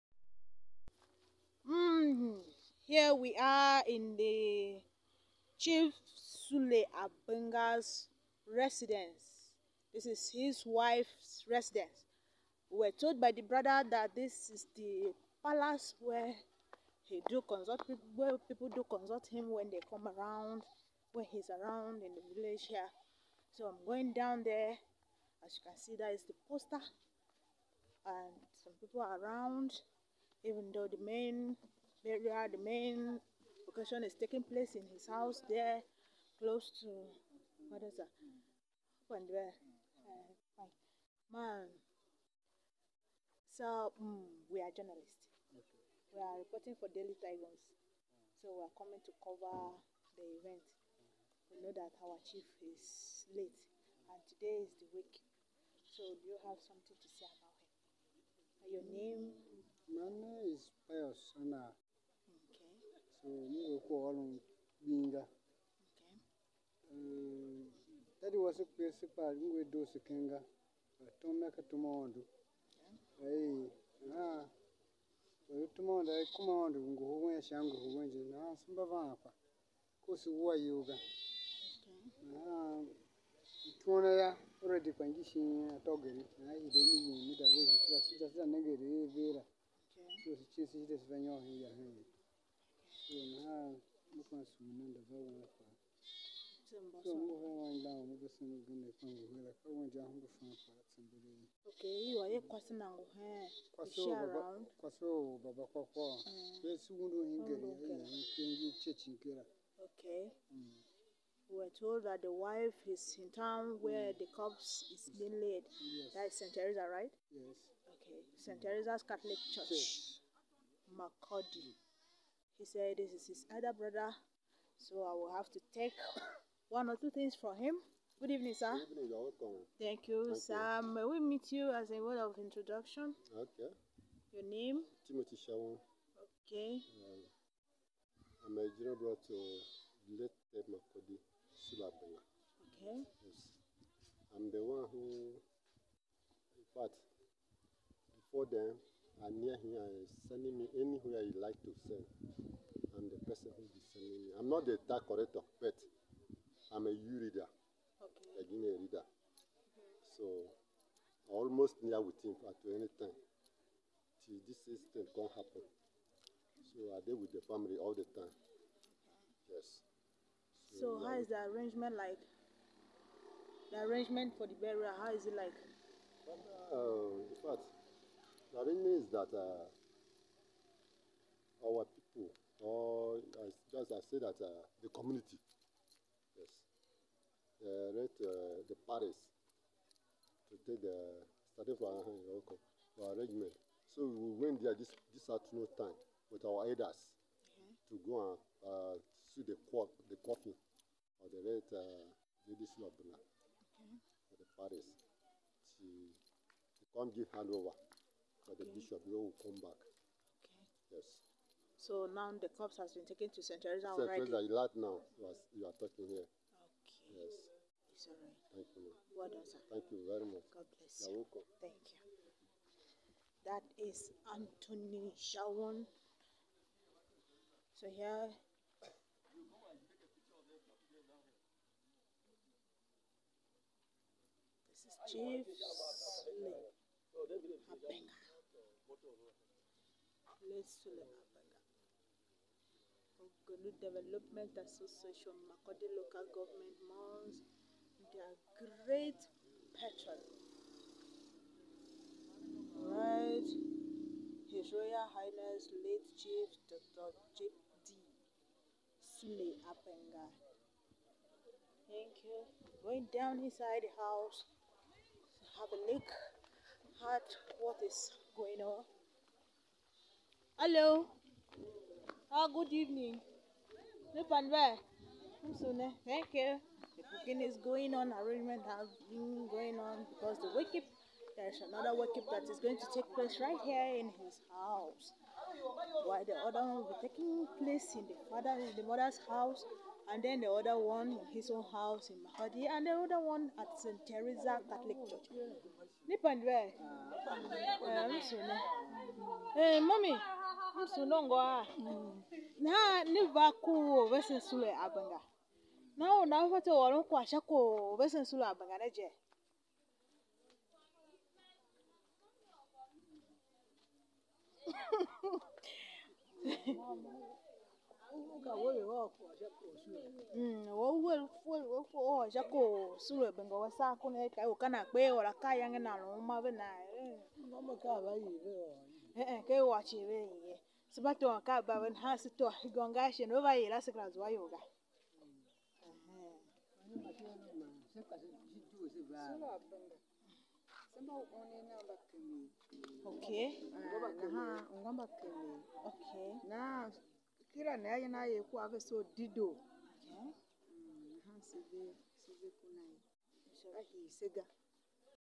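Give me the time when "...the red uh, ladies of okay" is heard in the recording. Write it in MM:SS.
03:21.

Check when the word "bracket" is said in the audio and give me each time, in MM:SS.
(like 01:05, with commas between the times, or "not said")
not said.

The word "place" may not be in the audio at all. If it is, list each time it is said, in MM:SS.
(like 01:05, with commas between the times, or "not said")
00:34, 04:00, 04:43, 04:47.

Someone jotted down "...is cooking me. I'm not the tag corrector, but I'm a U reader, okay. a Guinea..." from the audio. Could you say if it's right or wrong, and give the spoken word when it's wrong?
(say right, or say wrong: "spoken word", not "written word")
wrong: "sending", not "cooking".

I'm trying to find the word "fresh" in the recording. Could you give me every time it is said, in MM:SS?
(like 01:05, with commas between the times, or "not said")
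not said.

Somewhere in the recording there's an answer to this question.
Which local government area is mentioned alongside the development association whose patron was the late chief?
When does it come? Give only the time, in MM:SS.
04:05.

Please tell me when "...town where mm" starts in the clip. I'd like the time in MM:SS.
01:53.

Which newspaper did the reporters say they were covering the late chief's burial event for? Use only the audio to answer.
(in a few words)
Daily Tigers.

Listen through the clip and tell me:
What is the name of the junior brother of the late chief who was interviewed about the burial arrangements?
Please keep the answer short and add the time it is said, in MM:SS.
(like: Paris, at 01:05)
Timothy Shawon, at 02:15.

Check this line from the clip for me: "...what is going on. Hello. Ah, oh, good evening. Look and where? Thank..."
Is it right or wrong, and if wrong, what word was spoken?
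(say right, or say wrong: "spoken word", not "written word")
right.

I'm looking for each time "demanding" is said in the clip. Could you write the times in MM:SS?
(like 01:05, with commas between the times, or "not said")
not said.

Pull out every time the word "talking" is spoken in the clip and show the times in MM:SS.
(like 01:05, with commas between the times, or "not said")
03:35.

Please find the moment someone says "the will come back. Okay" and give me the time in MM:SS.
03:28.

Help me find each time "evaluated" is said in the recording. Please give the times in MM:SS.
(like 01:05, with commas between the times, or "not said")
not said.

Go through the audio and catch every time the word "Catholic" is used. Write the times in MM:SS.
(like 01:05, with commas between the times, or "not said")
01:59, 04:54.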